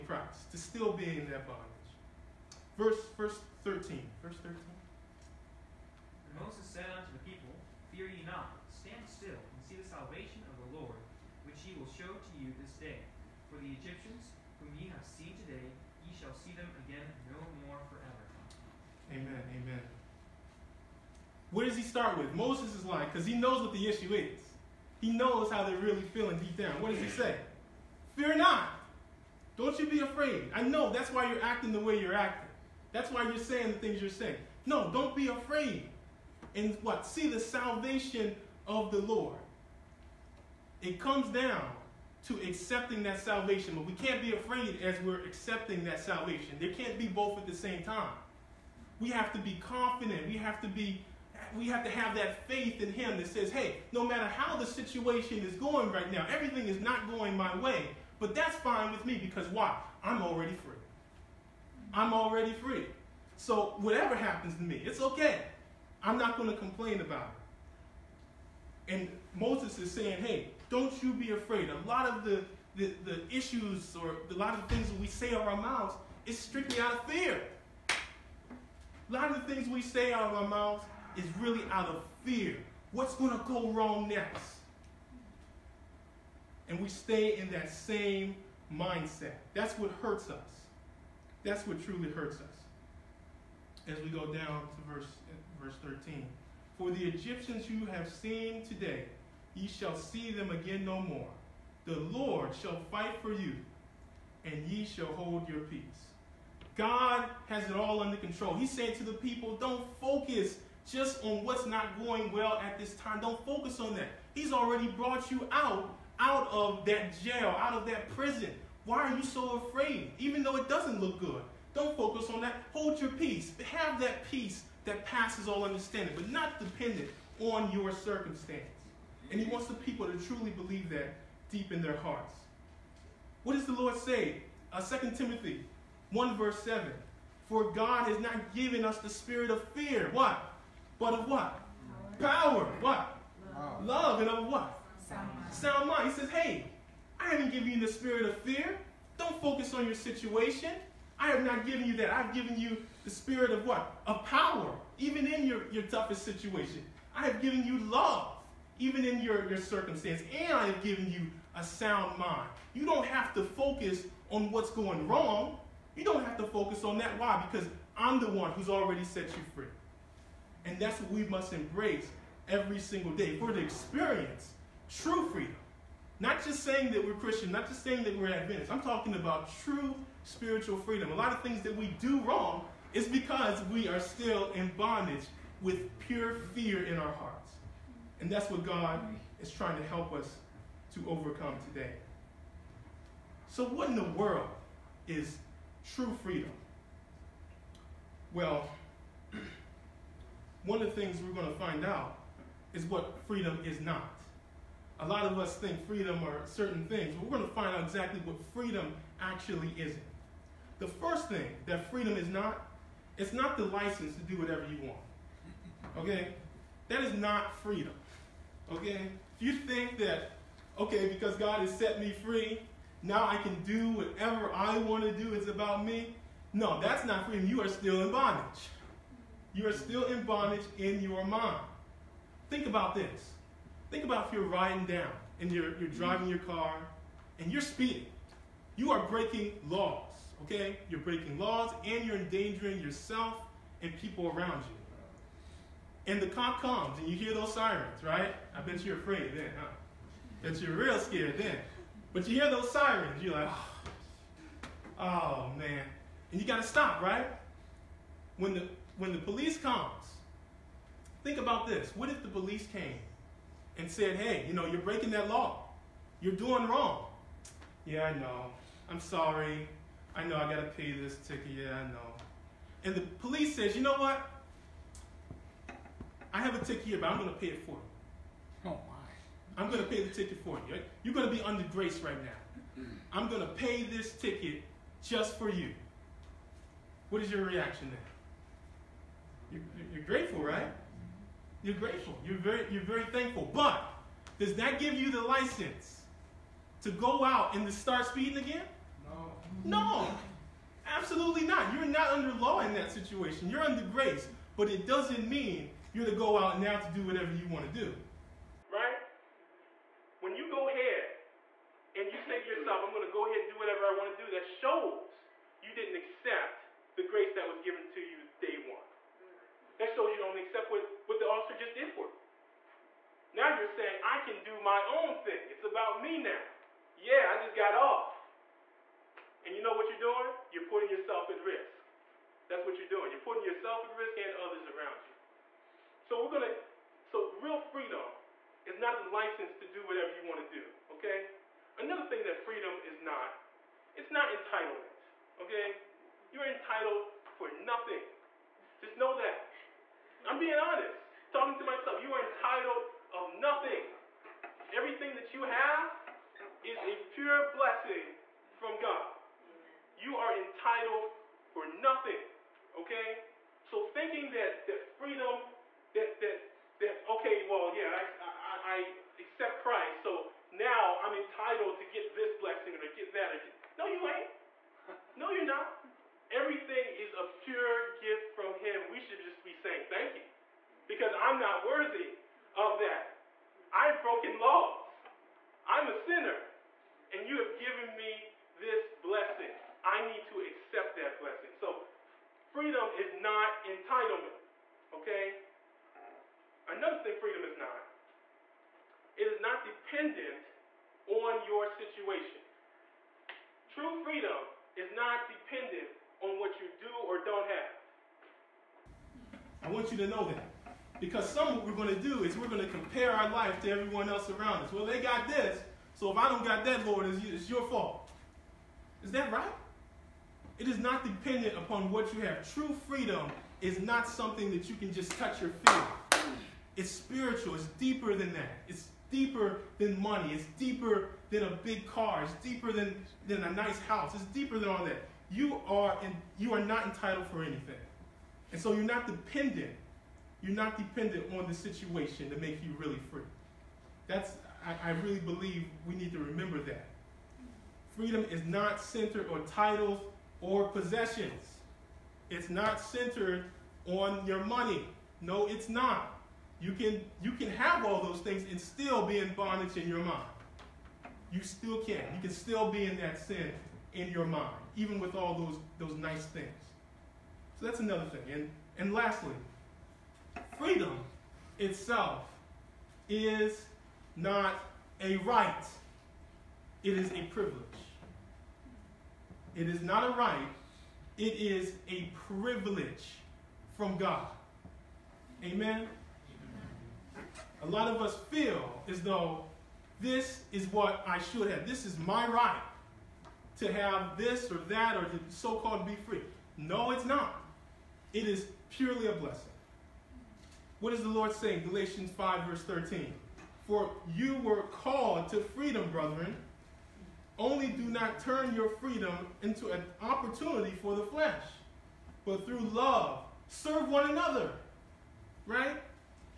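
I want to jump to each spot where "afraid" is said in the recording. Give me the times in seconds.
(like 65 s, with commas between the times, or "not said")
29 s, 35 s, 44 s, 71 s, 119 s, 248 s.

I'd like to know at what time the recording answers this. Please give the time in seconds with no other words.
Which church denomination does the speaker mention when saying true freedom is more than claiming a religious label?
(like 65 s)
178 s.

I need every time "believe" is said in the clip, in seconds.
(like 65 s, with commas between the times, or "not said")
130 s, 445 s.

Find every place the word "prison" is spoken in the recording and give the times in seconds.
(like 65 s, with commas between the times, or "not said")
118 s.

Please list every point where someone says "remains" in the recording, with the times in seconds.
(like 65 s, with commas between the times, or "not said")
not said.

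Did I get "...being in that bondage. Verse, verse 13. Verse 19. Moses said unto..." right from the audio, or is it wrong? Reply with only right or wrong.
wrong.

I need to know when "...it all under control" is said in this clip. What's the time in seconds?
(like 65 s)
107 s.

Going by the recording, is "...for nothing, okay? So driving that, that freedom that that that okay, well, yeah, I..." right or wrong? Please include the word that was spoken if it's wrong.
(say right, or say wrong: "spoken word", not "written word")
wrong: "thinking", not "driving".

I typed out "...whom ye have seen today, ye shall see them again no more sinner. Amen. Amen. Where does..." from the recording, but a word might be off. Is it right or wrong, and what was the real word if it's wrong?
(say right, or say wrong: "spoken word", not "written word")
wrong: "forever", not "sinner".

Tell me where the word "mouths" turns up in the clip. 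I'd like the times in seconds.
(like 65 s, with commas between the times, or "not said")
75 s, 80 s.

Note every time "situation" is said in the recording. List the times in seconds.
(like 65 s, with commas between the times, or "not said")
54 s, 149 s, 156 s, 302 s, 401 s, 441 s.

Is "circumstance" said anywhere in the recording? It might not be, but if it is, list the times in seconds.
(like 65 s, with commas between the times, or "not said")
127 s, 159 s.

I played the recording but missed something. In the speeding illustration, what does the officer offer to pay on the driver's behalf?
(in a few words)
The ticket.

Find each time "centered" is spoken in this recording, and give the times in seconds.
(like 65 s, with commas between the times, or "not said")
448 s, 452 s.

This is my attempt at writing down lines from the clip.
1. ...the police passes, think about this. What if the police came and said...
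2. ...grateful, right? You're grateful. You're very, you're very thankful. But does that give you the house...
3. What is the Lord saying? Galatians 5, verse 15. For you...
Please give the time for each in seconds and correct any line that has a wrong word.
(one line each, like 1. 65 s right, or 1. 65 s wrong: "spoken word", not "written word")
1. 259 s wrong: "comes", not "passes"
2. 290 s wrong: "license", not "house"
3. 500 s wrong: "13", not "15".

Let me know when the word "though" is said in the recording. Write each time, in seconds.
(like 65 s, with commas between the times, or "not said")
120 s, 489 s.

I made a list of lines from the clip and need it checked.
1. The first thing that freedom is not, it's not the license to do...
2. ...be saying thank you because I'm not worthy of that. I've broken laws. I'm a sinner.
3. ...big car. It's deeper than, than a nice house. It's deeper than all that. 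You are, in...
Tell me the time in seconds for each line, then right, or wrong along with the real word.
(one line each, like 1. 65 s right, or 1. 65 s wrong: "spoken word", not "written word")
1. 210 s right
2. 379 s right
3. 431 s right.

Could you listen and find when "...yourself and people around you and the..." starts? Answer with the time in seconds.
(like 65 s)
242 s.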